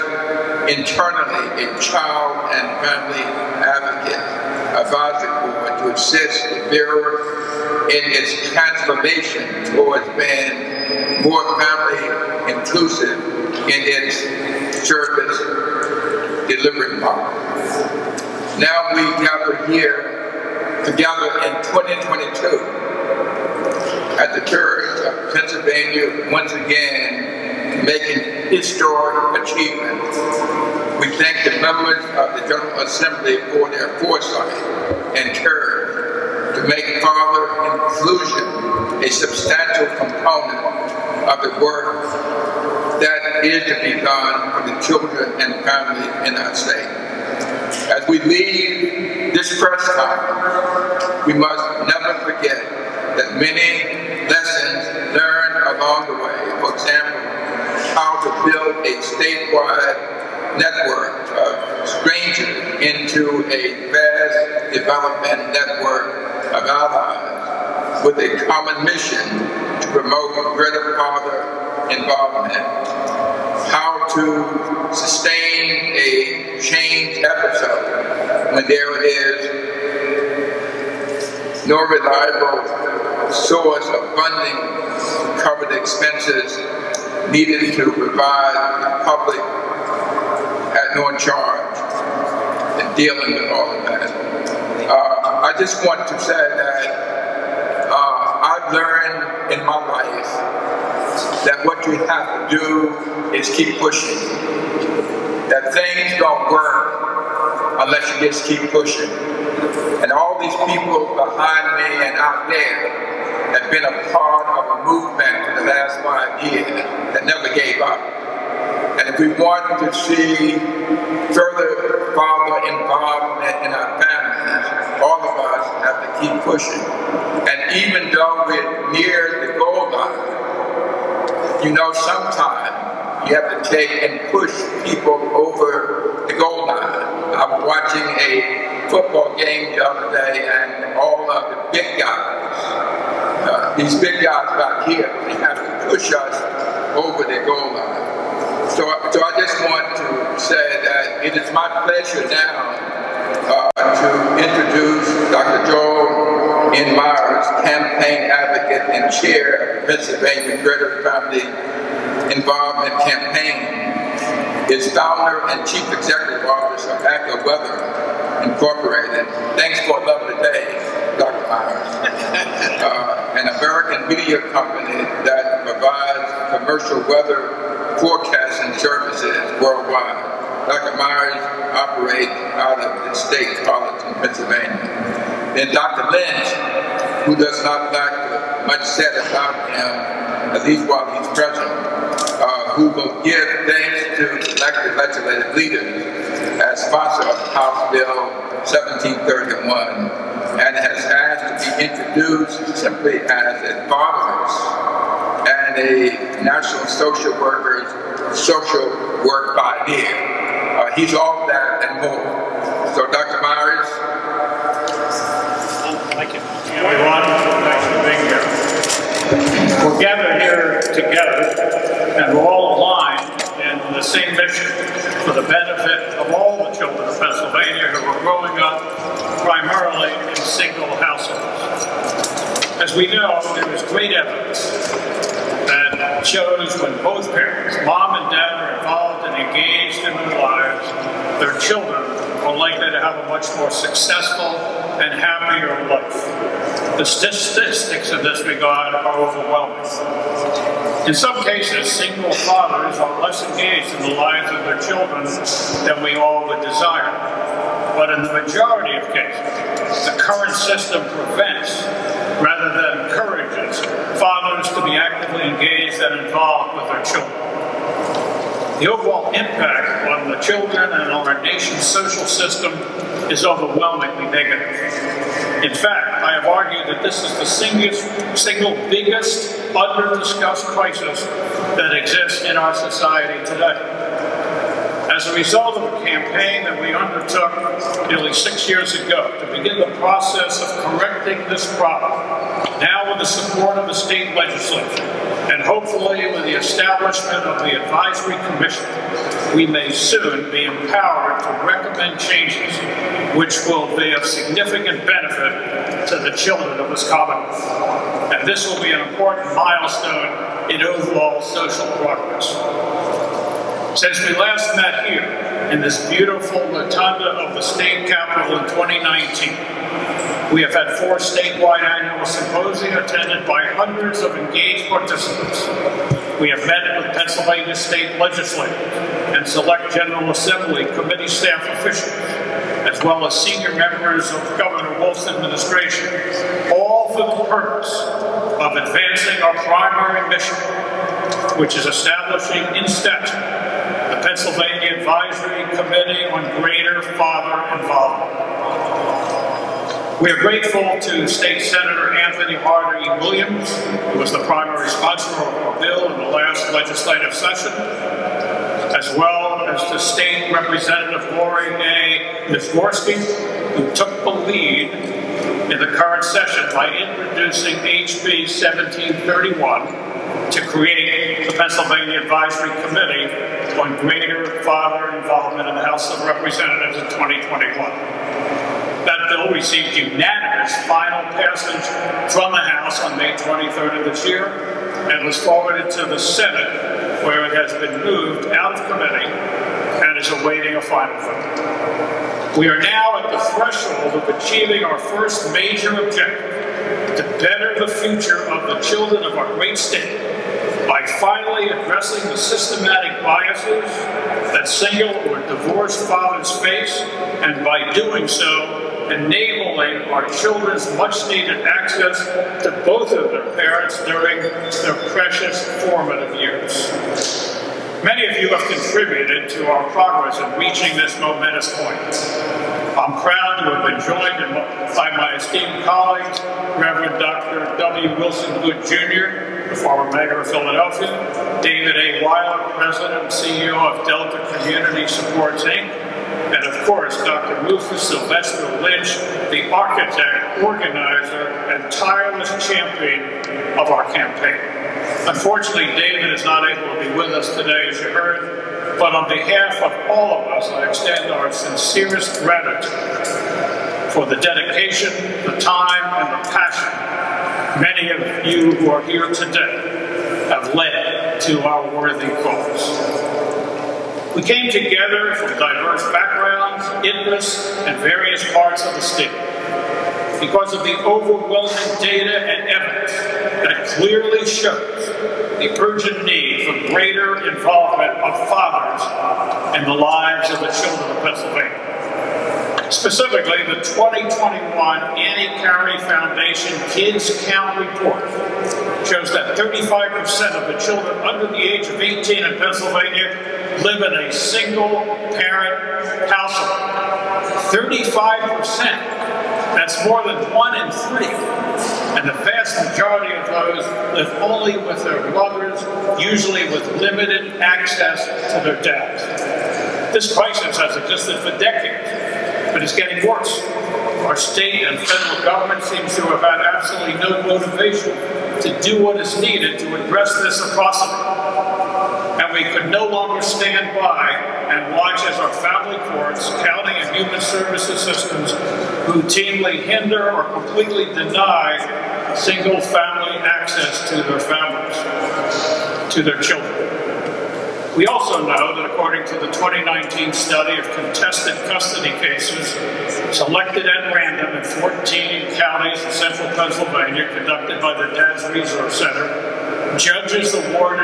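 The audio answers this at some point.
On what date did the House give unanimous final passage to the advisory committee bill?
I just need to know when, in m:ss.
6:23.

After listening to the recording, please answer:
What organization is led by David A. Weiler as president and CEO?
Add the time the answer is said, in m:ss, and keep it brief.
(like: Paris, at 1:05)
Delta Community Supports, at 7:14.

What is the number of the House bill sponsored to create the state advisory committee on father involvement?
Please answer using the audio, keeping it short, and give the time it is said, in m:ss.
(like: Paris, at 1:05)
1731, at 3:17.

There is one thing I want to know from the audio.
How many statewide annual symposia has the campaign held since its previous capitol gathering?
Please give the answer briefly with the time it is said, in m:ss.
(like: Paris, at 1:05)
4, at 5:20.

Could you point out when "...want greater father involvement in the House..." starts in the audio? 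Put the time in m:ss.
6:13.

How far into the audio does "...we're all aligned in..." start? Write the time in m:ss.
3:42.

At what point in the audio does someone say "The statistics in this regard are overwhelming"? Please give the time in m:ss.
4:06.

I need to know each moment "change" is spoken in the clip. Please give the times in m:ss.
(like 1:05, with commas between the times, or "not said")
1:16, 5:02.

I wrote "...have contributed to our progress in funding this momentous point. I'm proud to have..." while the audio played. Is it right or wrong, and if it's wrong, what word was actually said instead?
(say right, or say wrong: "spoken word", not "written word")
wrong: "reaching", not "funding".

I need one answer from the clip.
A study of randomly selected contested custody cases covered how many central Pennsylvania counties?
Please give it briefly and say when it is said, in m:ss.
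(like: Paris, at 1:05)
14, at 9:04.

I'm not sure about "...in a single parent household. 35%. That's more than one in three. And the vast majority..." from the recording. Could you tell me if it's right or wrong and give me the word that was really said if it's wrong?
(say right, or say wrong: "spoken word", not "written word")
right.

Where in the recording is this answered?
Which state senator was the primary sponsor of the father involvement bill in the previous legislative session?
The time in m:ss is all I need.
5:52.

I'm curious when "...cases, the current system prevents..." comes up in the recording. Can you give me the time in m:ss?
4:19.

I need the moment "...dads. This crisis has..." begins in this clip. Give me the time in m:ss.
8:28.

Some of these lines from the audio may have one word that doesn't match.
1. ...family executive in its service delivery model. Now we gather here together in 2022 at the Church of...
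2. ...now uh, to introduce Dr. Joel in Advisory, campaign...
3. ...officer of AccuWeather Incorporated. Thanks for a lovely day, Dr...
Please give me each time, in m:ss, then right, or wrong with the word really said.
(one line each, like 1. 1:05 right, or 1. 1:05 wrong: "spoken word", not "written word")
1. 0:11 wrong: "inclusive", not "executive"
2. 2:32 wrong: "Myers", not "Advisory"
3. 2:46 right.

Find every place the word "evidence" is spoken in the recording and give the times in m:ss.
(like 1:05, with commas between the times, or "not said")
3:54, 7:52.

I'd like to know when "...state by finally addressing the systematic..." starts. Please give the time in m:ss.
6:39.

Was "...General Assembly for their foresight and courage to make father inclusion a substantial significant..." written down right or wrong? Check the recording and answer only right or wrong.
wrong.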